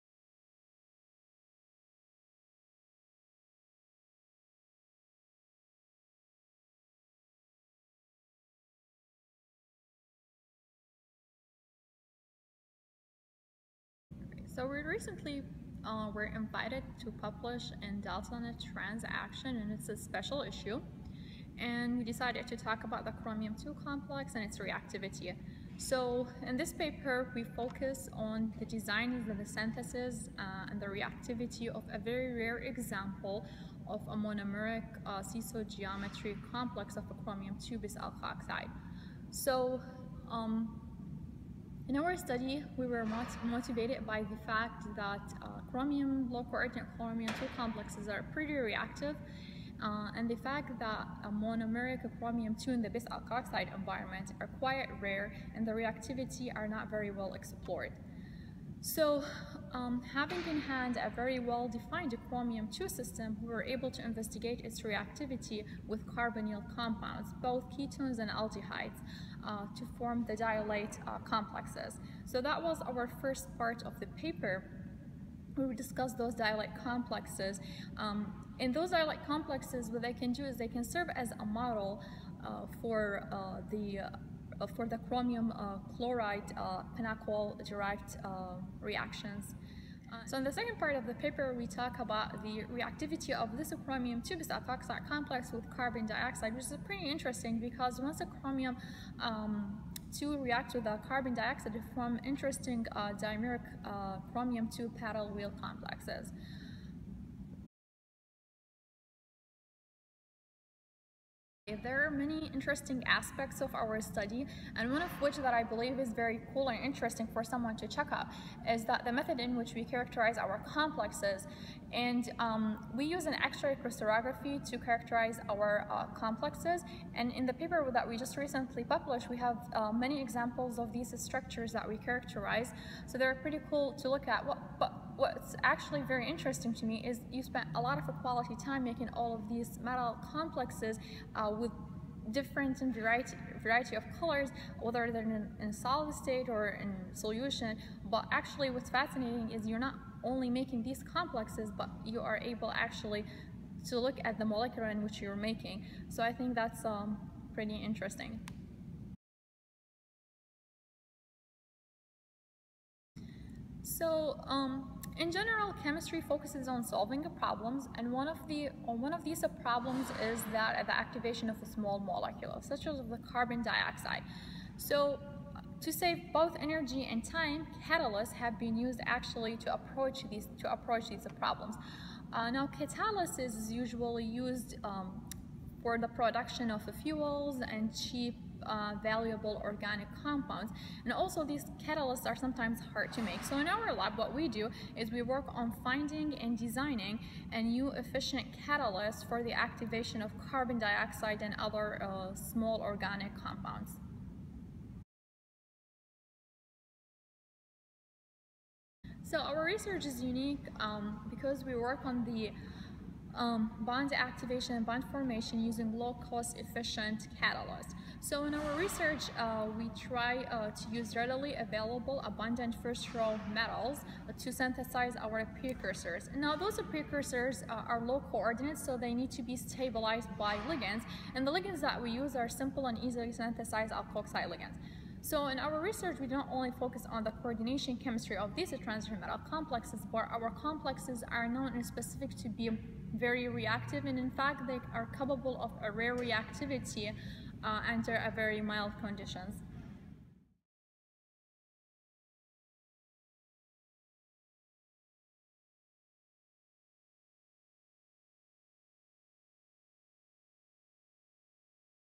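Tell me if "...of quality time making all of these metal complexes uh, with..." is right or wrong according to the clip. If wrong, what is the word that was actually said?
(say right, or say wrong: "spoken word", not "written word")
right.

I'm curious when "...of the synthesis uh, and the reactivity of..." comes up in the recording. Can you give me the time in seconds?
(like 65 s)
29 s.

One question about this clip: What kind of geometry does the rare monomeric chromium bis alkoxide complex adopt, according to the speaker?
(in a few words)
Seesaw.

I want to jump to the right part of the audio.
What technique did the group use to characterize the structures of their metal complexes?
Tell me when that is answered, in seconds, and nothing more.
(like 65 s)
123 s.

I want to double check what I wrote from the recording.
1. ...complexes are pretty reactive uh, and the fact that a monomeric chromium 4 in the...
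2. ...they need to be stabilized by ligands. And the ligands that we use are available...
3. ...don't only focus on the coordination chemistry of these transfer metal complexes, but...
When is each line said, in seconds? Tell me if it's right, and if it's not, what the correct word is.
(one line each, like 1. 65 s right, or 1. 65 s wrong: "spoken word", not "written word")
1. 47 s wrong: "2", not "4"
2. 228 s wrong: "simple", not "available"
3. 236 s right.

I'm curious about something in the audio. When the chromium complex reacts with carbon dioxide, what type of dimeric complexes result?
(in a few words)
Paddle wheel complexes.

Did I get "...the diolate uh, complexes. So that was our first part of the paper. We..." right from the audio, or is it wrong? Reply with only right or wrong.
right.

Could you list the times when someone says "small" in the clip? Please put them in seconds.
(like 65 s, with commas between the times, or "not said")
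171 s, 202 s.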